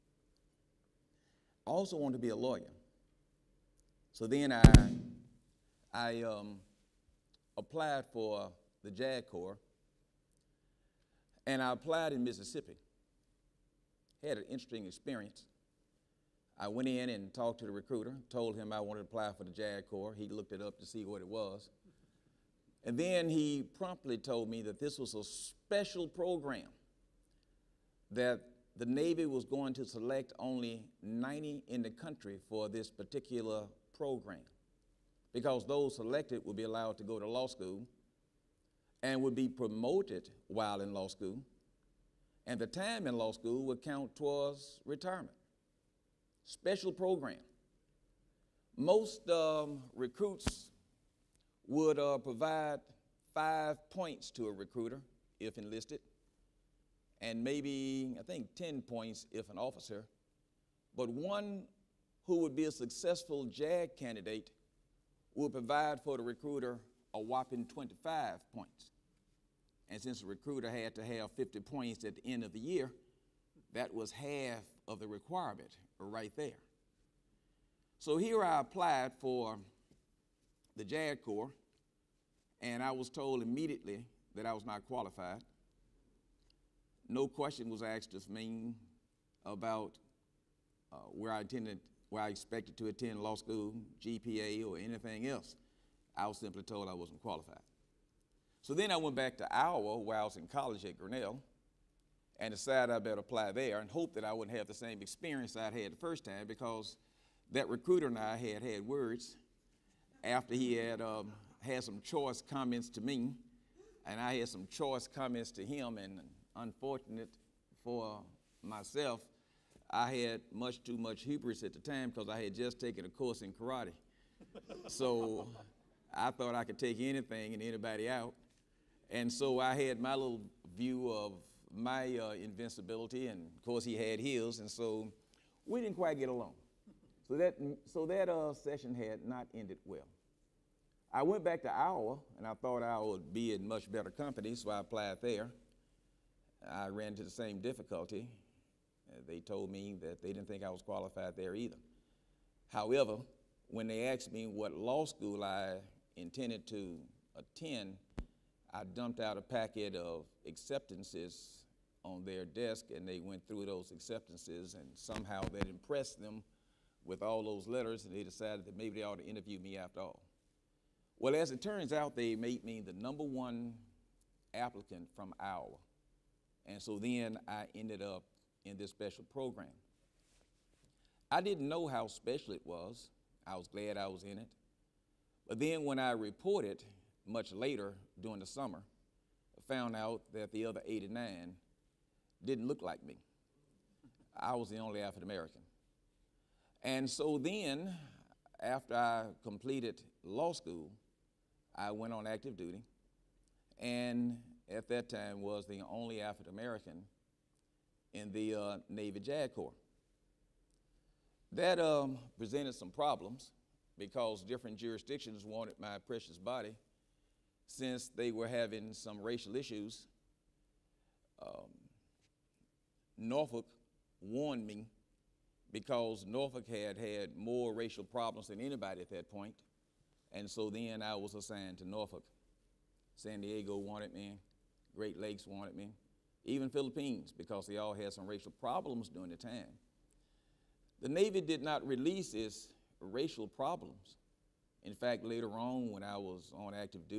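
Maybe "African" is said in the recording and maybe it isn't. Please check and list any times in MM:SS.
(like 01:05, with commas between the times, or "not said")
03:15, 03:26.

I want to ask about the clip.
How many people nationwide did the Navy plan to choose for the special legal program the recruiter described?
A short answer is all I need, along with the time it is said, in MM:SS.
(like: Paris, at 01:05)
90, at 00:31.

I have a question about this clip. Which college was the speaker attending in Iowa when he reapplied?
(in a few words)
Grinnell.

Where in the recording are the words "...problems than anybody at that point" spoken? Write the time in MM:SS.
03:48.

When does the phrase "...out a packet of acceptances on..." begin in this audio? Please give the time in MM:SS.
02:39.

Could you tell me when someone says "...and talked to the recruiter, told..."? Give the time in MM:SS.
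00:17.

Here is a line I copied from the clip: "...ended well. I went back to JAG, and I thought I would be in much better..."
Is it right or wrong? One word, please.
wrong.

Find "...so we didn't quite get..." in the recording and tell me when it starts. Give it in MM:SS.
02:14.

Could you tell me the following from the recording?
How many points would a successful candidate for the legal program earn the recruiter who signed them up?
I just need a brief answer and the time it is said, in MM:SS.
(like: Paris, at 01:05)
25, at 01:07.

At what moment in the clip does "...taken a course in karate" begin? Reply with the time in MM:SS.
02:02.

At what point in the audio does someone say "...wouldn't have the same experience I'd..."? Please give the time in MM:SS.
01:44.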